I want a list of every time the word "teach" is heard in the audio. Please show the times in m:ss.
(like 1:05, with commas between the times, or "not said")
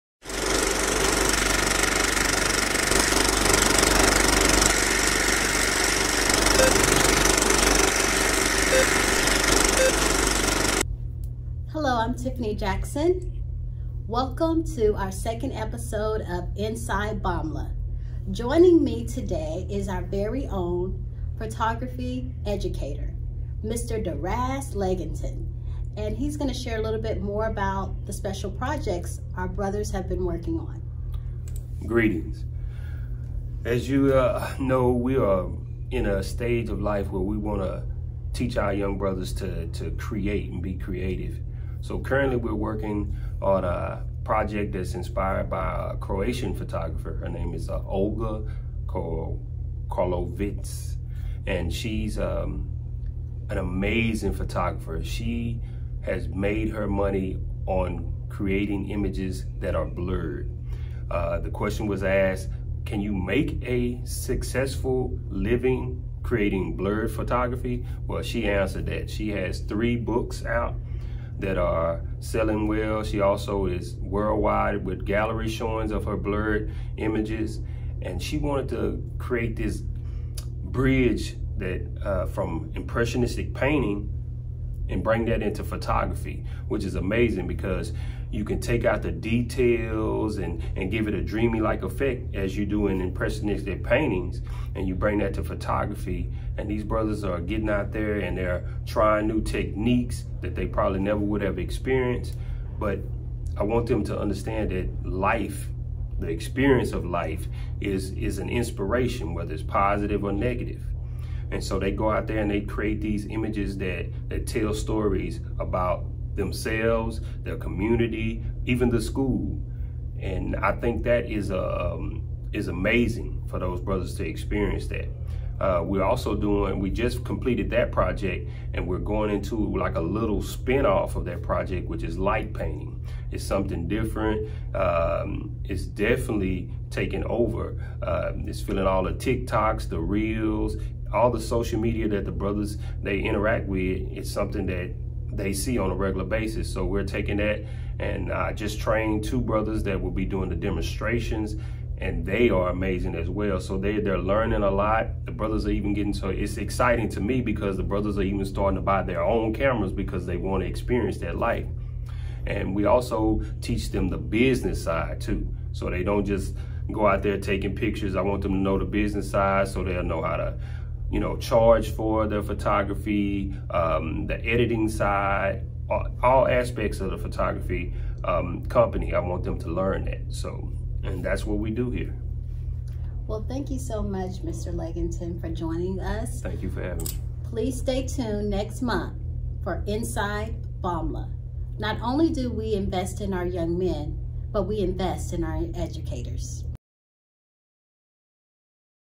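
0:38, 2:43.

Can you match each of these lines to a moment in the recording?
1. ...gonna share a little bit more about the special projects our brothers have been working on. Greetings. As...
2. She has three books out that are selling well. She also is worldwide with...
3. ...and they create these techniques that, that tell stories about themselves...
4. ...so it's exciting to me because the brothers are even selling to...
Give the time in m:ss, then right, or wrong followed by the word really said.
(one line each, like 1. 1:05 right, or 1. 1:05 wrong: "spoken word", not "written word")
1. 0:26 right
2. 1:09 right
3. 1:52 wrong: "images", not "techniques"
4. 2:36 wrong: "starting", not "selling".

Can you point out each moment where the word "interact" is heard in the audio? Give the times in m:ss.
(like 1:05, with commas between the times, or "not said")
2:23.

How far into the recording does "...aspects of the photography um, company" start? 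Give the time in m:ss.
2:56.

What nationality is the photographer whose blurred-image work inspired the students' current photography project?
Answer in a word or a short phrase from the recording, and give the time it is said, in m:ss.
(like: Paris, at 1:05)
Croatian, at 0:45.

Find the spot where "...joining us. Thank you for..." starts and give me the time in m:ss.
3:05.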